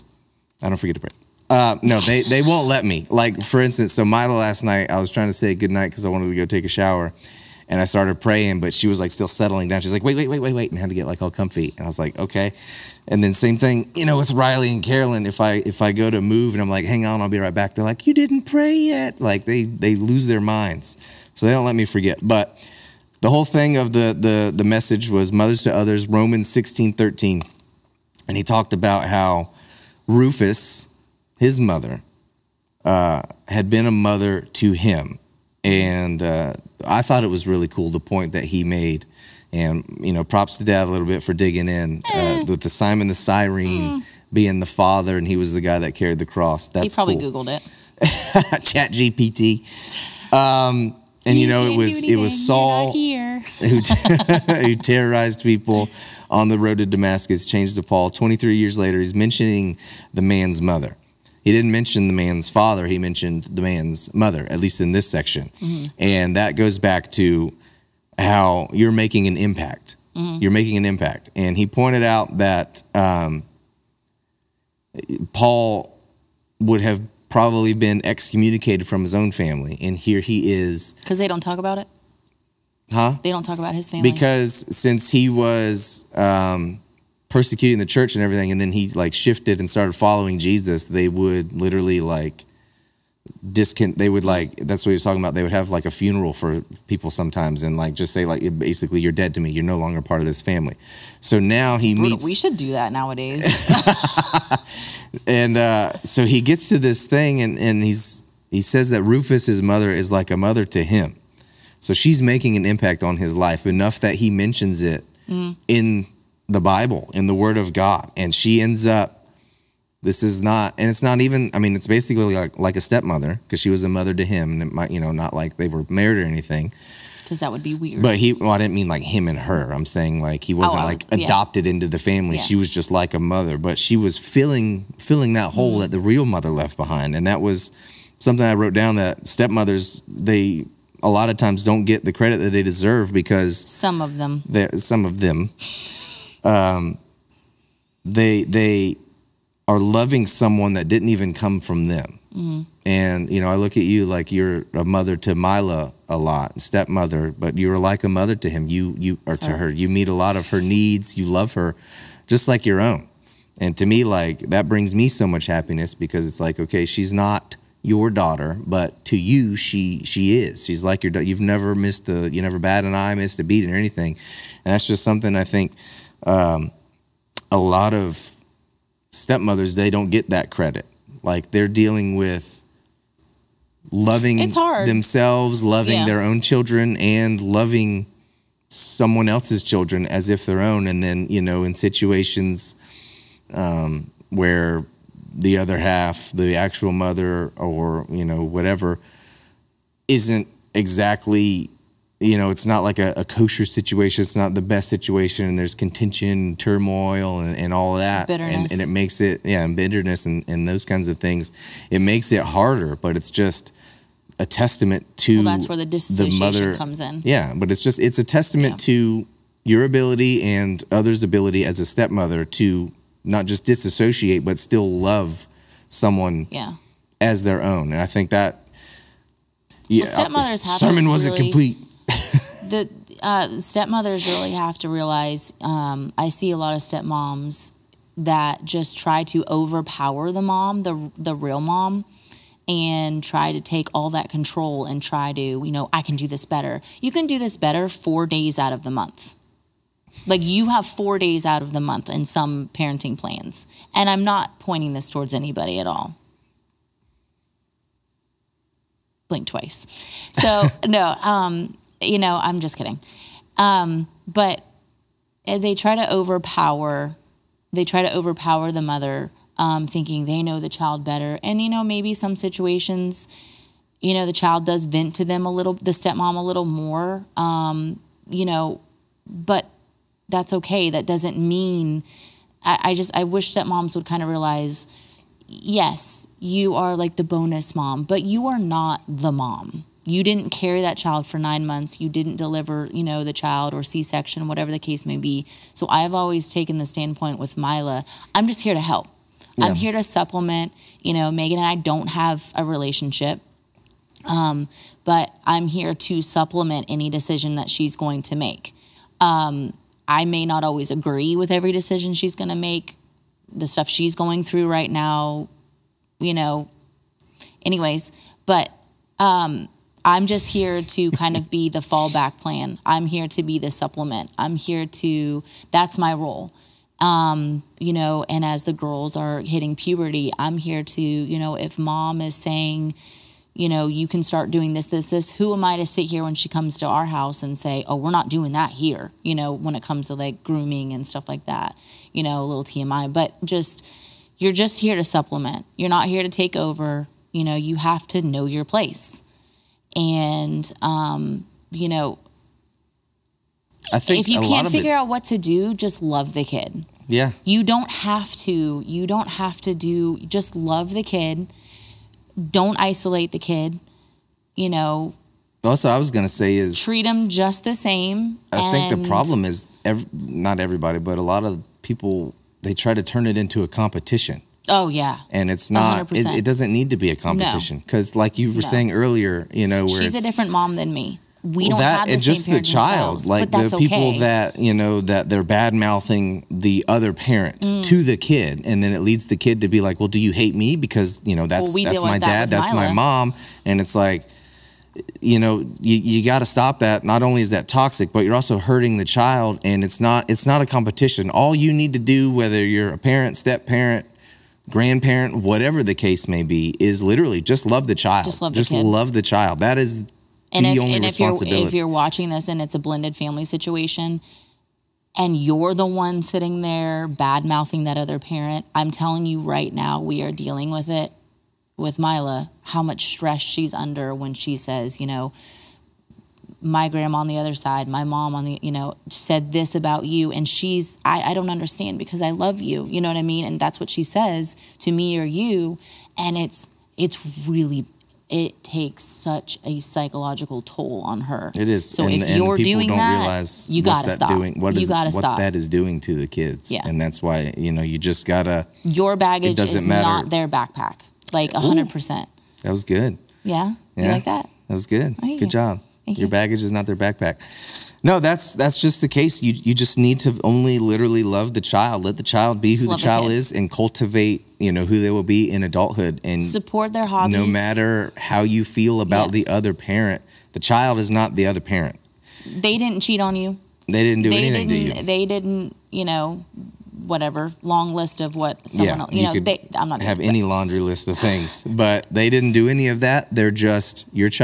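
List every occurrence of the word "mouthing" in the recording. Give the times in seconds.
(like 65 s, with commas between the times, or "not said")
385 s, 417 s.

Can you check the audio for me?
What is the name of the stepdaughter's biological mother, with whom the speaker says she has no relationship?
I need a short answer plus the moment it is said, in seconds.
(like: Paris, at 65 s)
Megan, at 301 s.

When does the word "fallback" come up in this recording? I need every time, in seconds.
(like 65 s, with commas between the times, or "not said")
321 s.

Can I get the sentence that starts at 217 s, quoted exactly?
Yeah, but it's just it's a testament yeah.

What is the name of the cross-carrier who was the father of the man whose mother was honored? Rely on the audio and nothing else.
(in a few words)
Simon the Cyrene.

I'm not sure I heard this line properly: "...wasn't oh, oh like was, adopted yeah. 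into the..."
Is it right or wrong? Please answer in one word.
right.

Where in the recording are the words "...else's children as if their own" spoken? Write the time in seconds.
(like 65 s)
189 s.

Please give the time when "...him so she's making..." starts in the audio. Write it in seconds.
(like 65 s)
110 s.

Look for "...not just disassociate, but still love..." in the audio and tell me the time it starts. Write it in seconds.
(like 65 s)
223 s.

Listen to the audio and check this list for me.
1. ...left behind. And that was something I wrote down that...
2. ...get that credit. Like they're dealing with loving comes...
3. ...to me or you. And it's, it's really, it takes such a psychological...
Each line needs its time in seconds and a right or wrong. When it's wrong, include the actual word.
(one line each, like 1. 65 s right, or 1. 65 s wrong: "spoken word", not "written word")
1. 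136 s right
2. 180 s wrong: "themselves", not "comes"
3. 434 s right.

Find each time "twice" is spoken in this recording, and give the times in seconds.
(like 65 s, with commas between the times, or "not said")
259 s.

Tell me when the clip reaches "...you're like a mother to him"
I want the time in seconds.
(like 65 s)
157 s.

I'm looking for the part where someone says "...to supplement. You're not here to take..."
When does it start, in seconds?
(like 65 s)
344 s.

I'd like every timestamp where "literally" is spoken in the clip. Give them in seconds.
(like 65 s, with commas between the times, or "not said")
91 s, 407 s, 460 s.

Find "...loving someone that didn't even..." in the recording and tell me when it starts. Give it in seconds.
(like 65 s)
149 s.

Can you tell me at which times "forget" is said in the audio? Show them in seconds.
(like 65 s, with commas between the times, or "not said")
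0 s, 21 s.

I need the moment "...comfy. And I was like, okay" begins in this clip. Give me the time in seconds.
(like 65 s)
11 s.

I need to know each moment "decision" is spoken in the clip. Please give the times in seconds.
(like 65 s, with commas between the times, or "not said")
307 s, 311 s.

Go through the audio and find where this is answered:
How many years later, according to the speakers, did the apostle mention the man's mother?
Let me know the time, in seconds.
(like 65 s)
58 s.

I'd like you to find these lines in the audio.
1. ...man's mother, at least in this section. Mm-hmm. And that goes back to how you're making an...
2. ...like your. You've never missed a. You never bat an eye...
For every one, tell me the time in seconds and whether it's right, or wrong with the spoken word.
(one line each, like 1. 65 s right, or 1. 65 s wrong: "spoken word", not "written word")
1. 63 s right
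2. 170 s right.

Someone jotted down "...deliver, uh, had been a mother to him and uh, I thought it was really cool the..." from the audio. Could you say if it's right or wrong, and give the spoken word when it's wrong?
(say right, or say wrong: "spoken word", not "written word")
wrong: "mother", not "deliver".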